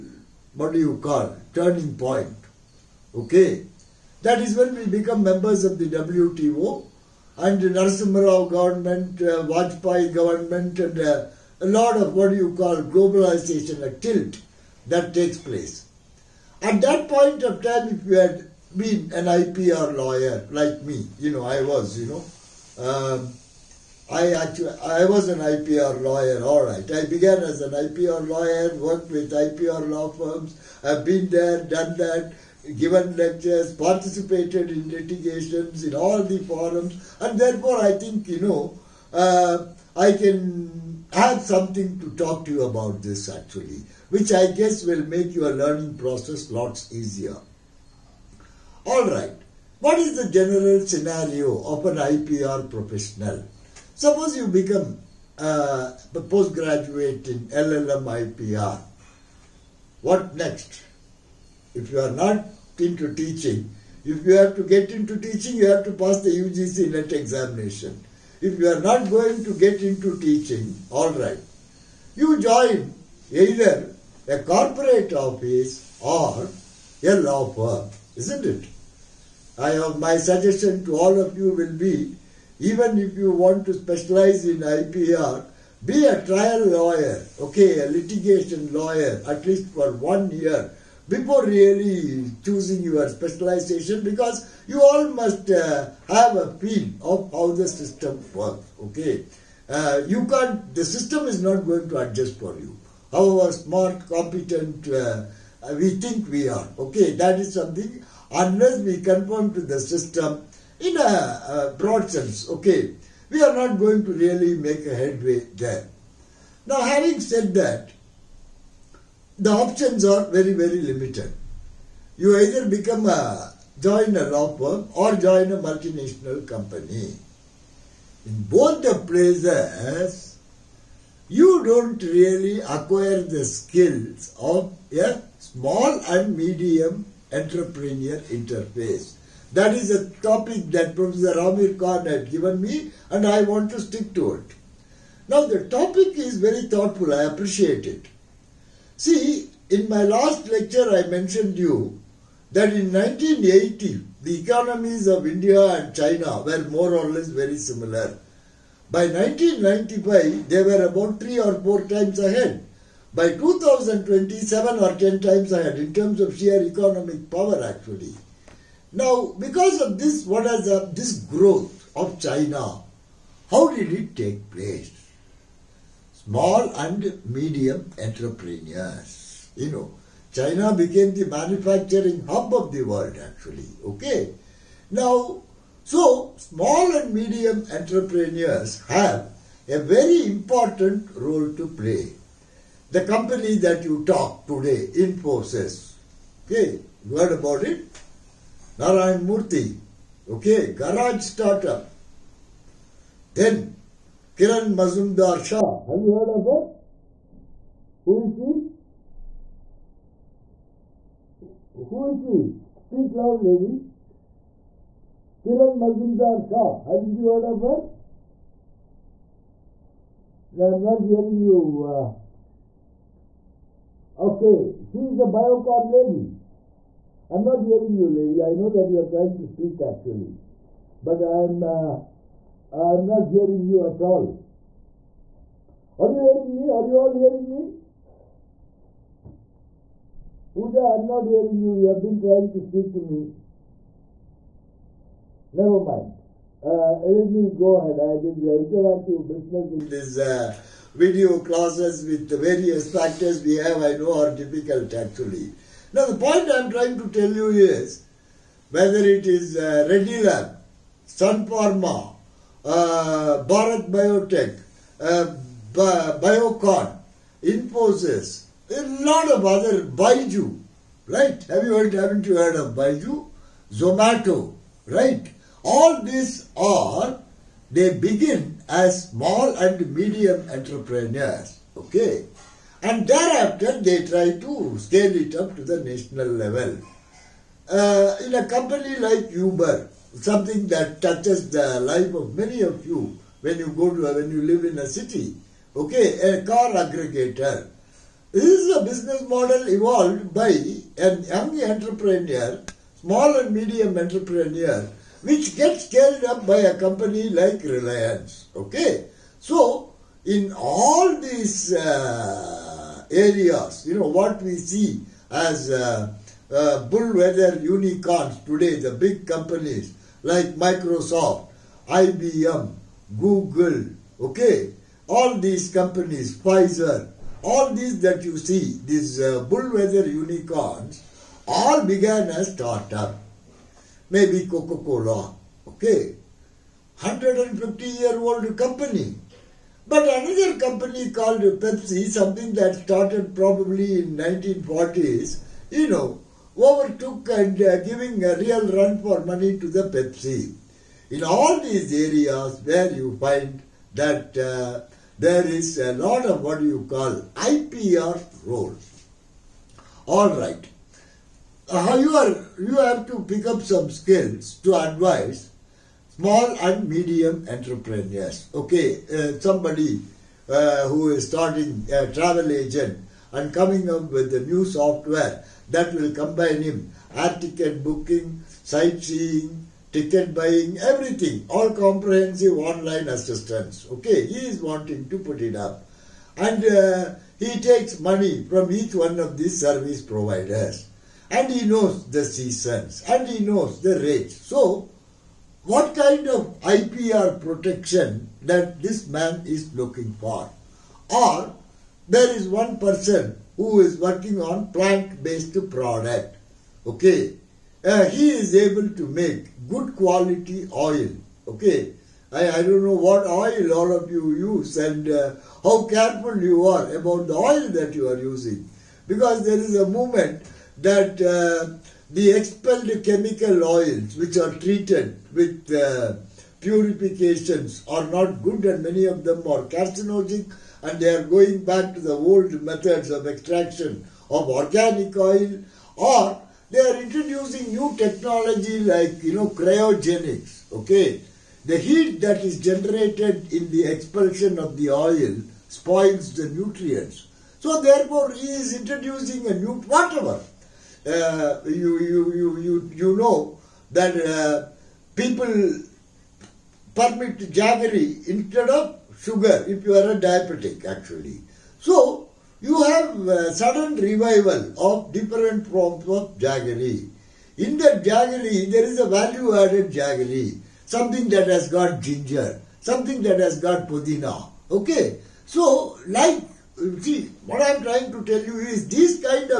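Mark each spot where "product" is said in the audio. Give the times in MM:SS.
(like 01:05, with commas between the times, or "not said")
06:45.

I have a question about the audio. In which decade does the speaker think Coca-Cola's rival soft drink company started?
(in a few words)
1940s.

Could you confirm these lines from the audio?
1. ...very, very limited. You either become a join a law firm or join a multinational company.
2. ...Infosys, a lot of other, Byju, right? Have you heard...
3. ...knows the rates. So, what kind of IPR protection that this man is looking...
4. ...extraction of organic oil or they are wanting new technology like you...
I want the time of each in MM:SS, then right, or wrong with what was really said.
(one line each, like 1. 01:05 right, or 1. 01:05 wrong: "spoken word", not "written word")
1. 02:00 right
2. 04:27 right
3. 06:33 right
4. 07:13 wrong: "introducing", not "wanting".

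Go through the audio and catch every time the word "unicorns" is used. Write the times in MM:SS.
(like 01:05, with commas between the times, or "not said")
05:17, 05:30.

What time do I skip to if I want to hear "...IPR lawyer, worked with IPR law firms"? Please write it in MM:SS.
00:27.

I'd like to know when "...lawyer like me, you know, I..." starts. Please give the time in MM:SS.
00:19.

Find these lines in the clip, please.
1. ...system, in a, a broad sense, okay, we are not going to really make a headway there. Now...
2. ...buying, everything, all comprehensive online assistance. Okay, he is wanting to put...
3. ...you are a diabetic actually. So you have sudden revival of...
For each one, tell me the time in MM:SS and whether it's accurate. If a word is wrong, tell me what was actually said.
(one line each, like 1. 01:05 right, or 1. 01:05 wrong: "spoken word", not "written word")
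1. 01:49 right
2. 06:20 right
3. 07:39 right.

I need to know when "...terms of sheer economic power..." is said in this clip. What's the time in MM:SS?
02:45.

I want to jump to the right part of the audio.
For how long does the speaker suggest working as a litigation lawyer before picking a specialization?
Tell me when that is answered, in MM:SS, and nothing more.
01:29.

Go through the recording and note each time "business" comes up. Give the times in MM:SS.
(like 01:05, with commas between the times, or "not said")
04:09, 04:58.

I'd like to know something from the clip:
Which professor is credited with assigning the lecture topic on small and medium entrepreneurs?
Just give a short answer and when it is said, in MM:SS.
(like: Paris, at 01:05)
Ramir Khan, at 02:21.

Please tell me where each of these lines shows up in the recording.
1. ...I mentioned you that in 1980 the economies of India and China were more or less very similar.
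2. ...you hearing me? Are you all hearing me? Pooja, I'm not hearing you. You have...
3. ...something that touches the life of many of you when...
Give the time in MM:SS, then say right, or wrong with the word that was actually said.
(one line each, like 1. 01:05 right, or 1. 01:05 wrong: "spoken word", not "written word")
1. 02:30 right
2. 03:56 right
3. 04:50 right.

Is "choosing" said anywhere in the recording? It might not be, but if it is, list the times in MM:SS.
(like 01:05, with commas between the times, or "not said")
01:32.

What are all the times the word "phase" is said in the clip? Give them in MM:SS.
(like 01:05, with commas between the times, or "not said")
not said.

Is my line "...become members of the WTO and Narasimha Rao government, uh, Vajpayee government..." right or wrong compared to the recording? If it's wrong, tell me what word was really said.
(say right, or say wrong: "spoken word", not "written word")
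right.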